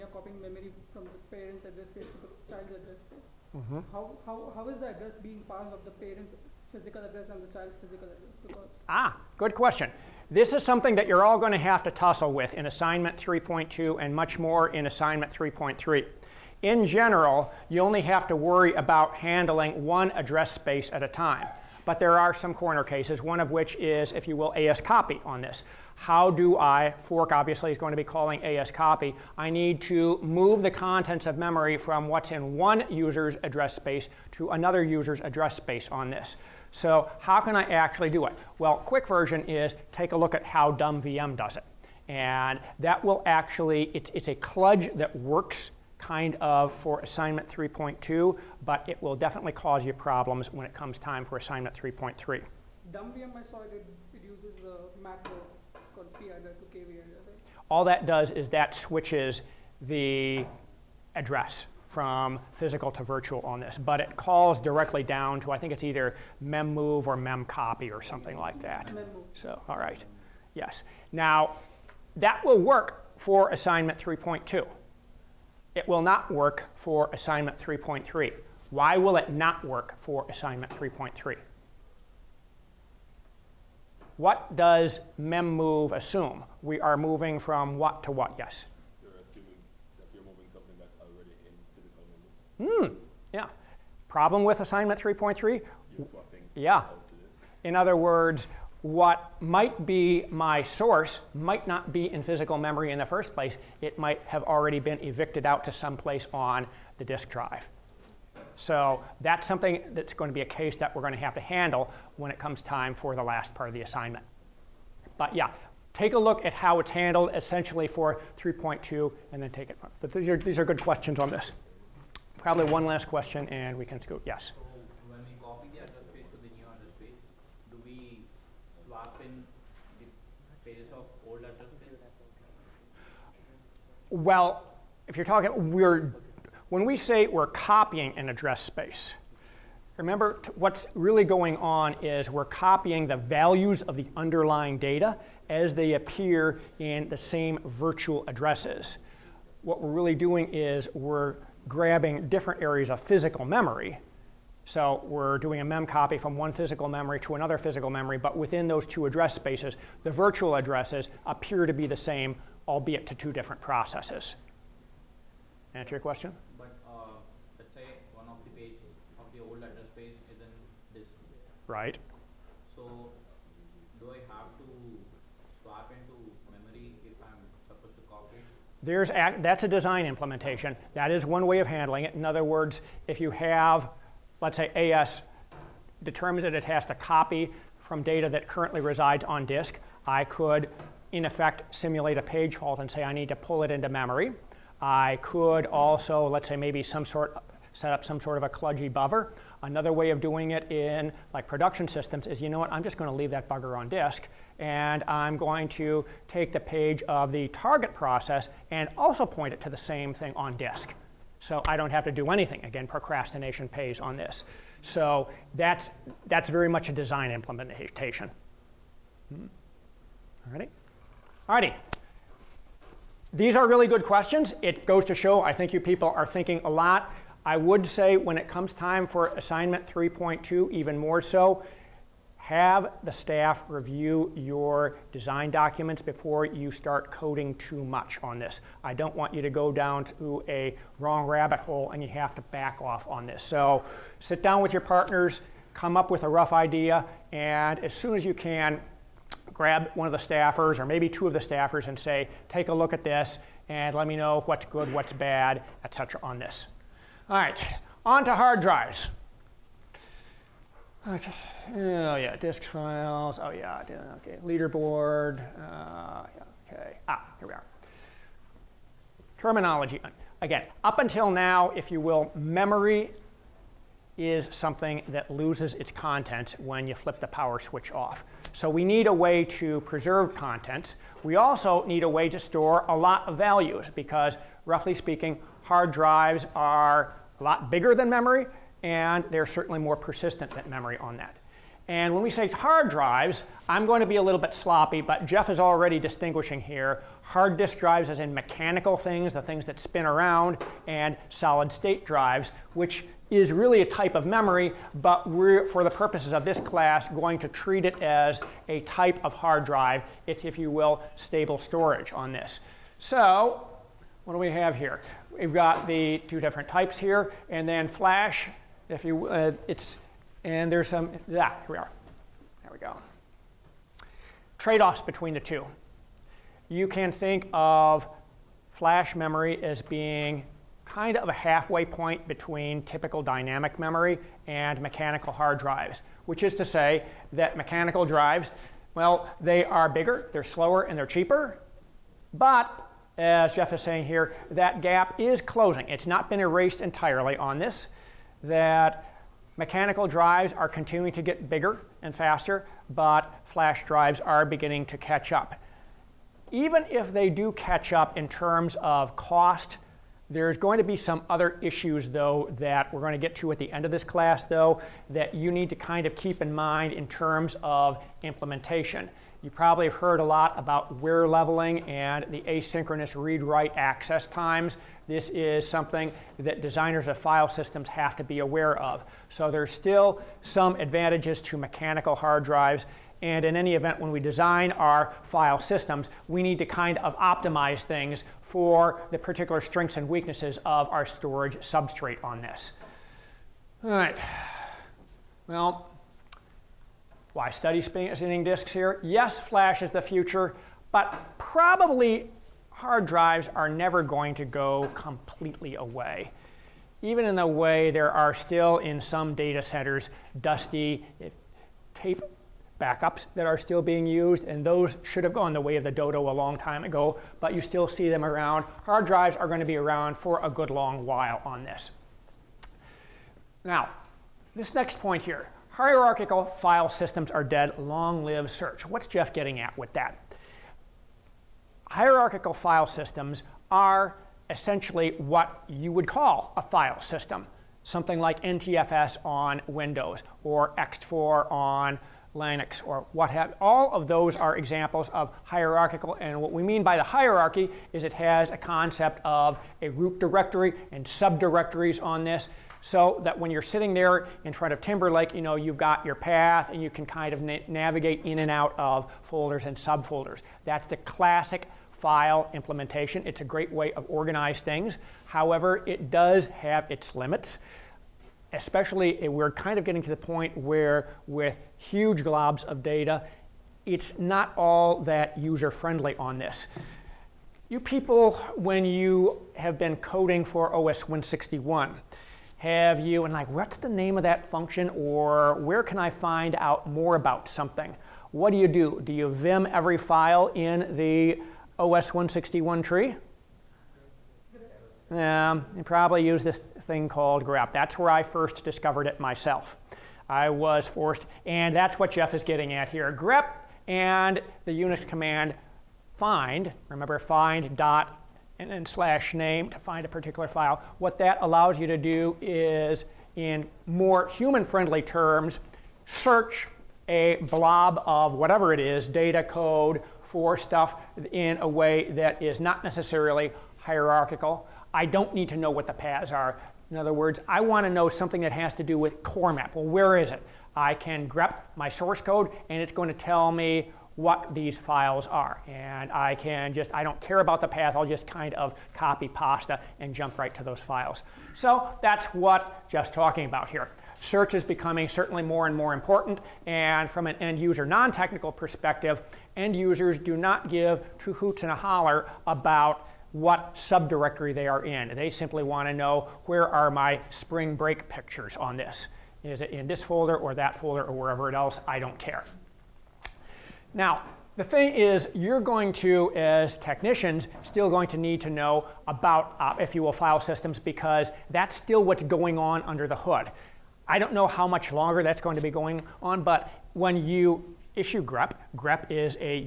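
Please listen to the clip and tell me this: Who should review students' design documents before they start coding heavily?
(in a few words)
the staff.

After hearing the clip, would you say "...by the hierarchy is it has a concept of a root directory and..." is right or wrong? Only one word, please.
right.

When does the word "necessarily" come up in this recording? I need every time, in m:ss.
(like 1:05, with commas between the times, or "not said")
8:42.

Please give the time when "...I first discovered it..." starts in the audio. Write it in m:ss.
8:18.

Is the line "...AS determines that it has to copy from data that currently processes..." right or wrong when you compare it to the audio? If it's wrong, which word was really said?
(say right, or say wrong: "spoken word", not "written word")
wrong: "resides", not "processes".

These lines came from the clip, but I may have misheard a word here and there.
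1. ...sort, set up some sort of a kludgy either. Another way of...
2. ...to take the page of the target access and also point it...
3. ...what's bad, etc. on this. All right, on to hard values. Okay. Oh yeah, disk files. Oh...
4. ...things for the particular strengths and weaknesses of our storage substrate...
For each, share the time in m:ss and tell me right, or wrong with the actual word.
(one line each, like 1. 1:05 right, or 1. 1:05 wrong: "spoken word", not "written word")
1. 3:17 wrong: "buffer", not "either"
2. 3:25 wrong: "process", not "access"
3. 4:14 wrong: "drives", not "values"
4. 6:27 right.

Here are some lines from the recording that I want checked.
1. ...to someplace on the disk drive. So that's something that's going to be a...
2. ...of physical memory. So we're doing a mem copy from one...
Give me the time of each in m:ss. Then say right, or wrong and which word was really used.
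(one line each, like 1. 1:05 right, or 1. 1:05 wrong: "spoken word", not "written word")
1. 1:45 right
2. 2:32 right.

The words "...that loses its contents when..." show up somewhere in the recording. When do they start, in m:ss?
4:35.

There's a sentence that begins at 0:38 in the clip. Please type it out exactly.
Well, quick version is take a look at how dumb VM does it.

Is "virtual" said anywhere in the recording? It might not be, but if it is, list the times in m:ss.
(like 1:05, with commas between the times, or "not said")
1:03, 2:27, 2:40.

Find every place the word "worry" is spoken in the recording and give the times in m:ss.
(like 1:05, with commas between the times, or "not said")
0:18.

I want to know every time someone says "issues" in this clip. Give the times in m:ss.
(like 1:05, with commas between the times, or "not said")
6:01, 9:37.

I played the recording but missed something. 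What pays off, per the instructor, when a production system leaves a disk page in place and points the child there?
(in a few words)
procrastination.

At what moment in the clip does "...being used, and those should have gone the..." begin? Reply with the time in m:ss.
6:53.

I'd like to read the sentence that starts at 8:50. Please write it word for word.
I can grep my source code and it's going to tell me what these files are.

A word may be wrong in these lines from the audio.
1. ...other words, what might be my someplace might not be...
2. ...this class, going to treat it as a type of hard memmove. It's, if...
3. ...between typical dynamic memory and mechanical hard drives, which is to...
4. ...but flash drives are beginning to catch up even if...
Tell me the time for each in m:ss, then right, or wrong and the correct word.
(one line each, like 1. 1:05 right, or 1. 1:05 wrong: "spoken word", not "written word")
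1. 1:37 wrong: "source", not "someplace"
2. 5:06 wrong: "drive", not "memmove"
3. 5:32 right
4. 5:52 right.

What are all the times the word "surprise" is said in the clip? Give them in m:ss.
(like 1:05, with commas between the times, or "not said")
not said.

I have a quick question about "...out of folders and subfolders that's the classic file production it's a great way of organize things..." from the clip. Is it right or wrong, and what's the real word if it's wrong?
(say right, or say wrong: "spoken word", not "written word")
wrong: "implementation", not "production".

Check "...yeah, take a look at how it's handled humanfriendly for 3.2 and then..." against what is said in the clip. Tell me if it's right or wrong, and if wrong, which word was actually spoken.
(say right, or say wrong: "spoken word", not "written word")
wrong: "essentially", not "humanfriendly".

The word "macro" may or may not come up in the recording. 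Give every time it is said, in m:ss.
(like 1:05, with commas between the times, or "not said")
0:55.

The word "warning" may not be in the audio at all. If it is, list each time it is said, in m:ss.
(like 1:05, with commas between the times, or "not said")
not said.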